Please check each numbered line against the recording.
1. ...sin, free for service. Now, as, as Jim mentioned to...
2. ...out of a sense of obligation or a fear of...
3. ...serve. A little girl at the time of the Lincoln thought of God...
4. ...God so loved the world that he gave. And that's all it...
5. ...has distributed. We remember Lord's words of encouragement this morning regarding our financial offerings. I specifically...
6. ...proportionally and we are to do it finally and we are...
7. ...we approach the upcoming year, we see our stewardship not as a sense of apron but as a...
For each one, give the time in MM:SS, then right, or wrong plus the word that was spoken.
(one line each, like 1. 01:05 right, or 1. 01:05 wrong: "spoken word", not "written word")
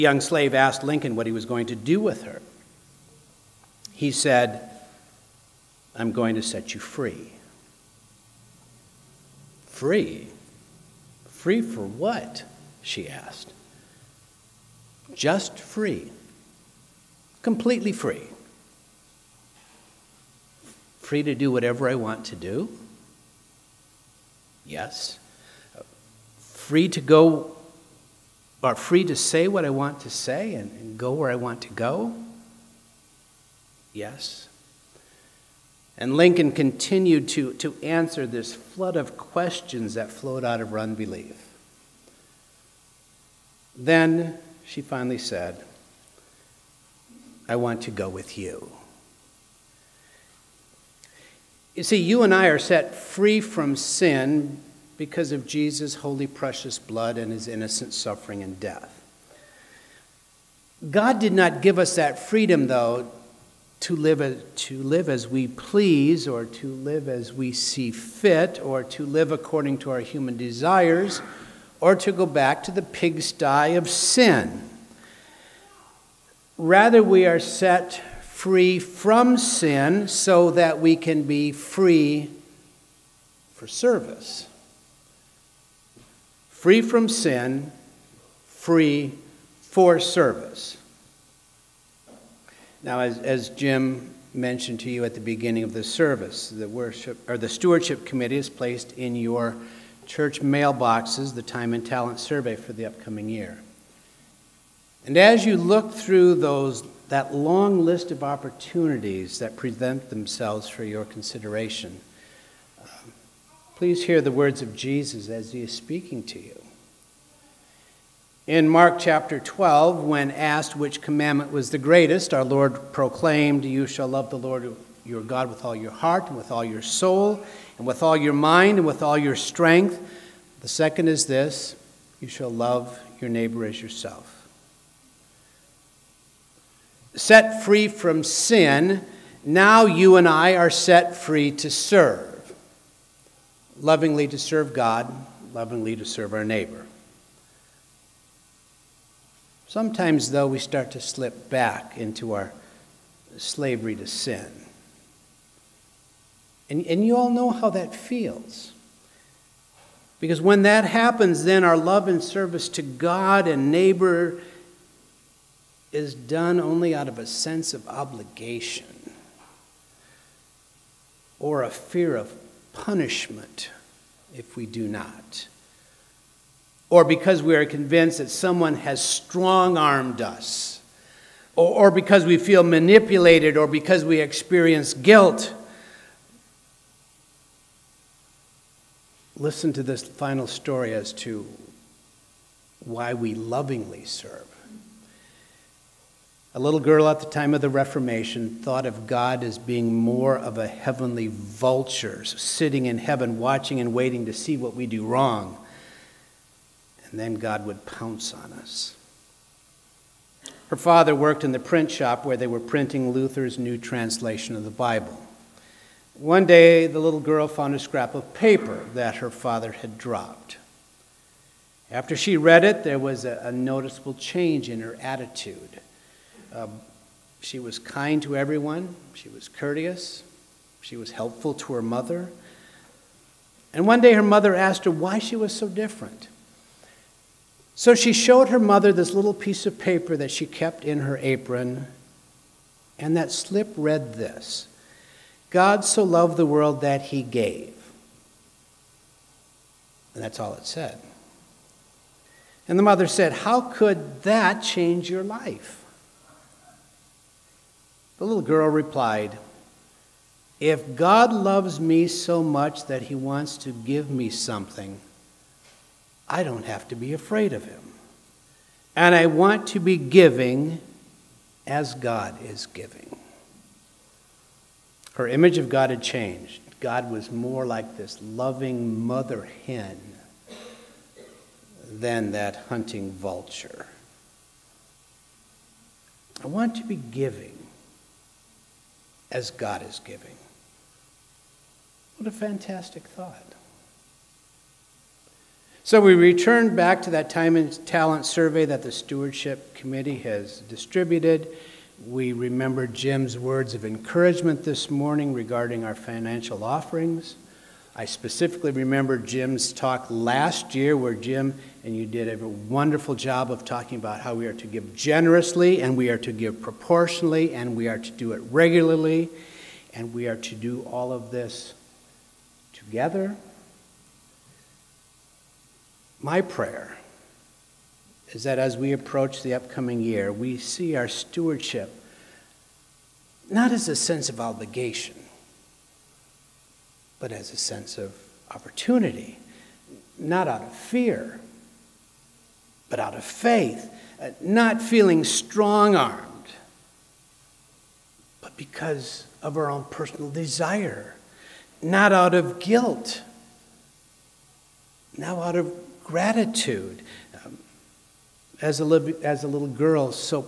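1. 01:27 right
2. 02:46 right
3. 03:14 wrong: "Reformation", not "Lincoln"
4. 04:05 right
5. 05:00 wrong: "Jim", not "Lord"
6. 05:16 wrong: "regularly", not "finally"
7. 05:28 wrong: "obligation", not "apron".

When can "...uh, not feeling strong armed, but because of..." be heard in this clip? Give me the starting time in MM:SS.
05:44.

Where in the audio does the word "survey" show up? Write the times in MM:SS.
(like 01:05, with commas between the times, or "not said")
01:42, 04:58.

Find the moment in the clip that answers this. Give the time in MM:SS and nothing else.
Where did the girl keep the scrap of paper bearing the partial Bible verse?
04:01.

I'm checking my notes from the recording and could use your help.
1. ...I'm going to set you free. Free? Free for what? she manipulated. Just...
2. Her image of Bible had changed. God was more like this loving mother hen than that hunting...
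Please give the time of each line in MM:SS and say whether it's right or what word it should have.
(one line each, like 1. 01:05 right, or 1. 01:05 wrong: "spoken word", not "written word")
1. 00:05 wrong: "asked", not "manipulated"
2. 04:35 wrong: "God", not "Bible".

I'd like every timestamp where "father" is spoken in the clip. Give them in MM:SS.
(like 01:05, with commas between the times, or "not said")
03:30, 03:39.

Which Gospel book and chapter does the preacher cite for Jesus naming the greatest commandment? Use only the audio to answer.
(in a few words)
Mark 12.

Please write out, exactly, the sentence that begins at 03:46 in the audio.
Um, she was kind to everyone, she was courteous, she was helpful to her mother.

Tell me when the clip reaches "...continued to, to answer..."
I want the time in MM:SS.
00:36.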